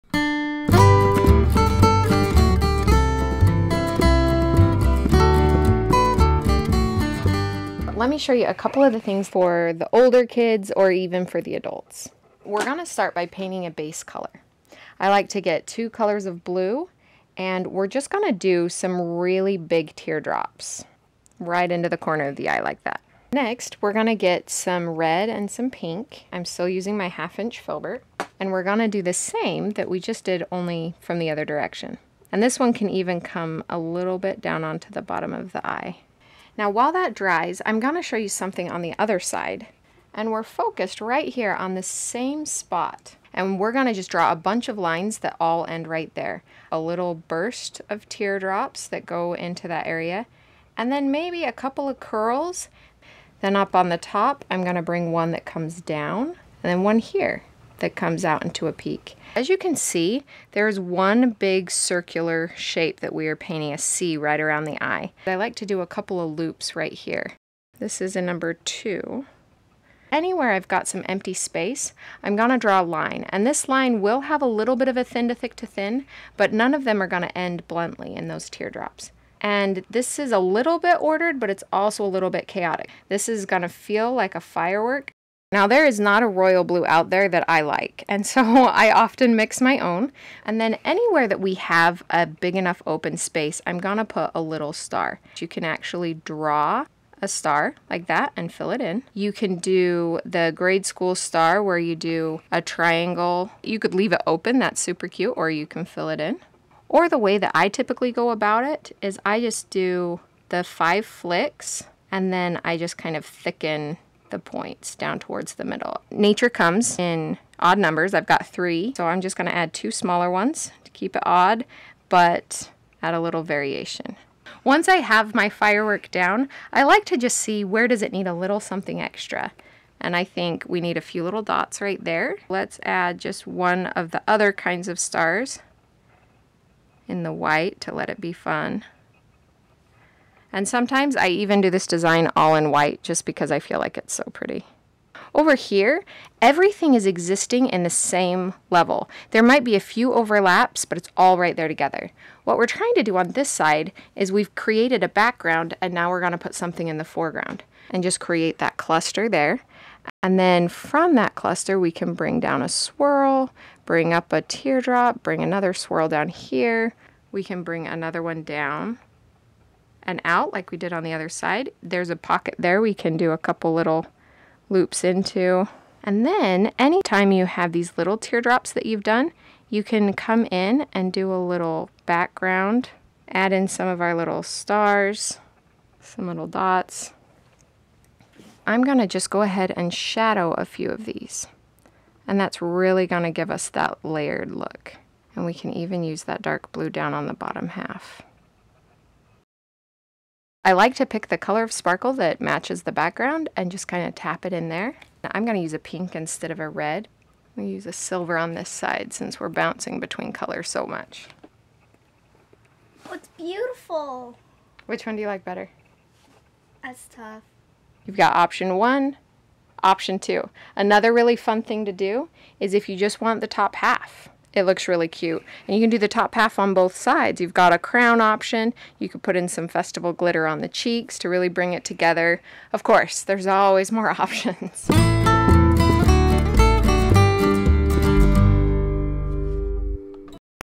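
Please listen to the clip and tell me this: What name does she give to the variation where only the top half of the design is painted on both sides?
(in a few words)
crown option.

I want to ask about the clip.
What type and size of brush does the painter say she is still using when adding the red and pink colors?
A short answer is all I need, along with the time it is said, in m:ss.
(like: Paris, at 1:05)
half inch filbert, at 0:27.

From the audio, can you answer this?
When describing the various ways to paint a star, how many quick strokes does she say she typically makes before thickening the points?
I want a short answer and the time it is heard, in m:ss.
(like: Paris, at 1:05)
5, at 1:50.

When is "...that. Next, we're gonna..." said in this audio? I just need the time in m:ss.
0:22.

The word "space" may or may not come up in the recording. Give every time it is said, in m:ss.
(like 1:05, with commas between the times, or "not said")
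1:11, 1:33.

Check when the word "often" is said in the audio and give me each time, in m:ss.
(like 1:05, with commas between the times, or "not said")
1:28.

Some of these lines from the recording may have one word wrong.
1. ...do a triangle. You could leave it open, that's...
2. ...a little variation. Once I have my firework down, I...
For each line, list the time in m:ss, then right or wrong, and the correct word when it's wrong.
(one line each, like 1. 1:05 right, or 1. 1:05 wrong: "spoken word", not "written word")
1. 1:41 right
2. 2:03 right.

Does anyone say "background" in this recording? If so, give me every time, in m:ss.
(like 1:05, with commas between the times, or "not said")
2:35, 3:02, 3:22.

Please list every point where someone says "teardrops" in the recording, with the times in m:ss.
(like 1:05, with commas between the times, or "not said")
0:19, 0:48, 1:18, 2:44, 2:58.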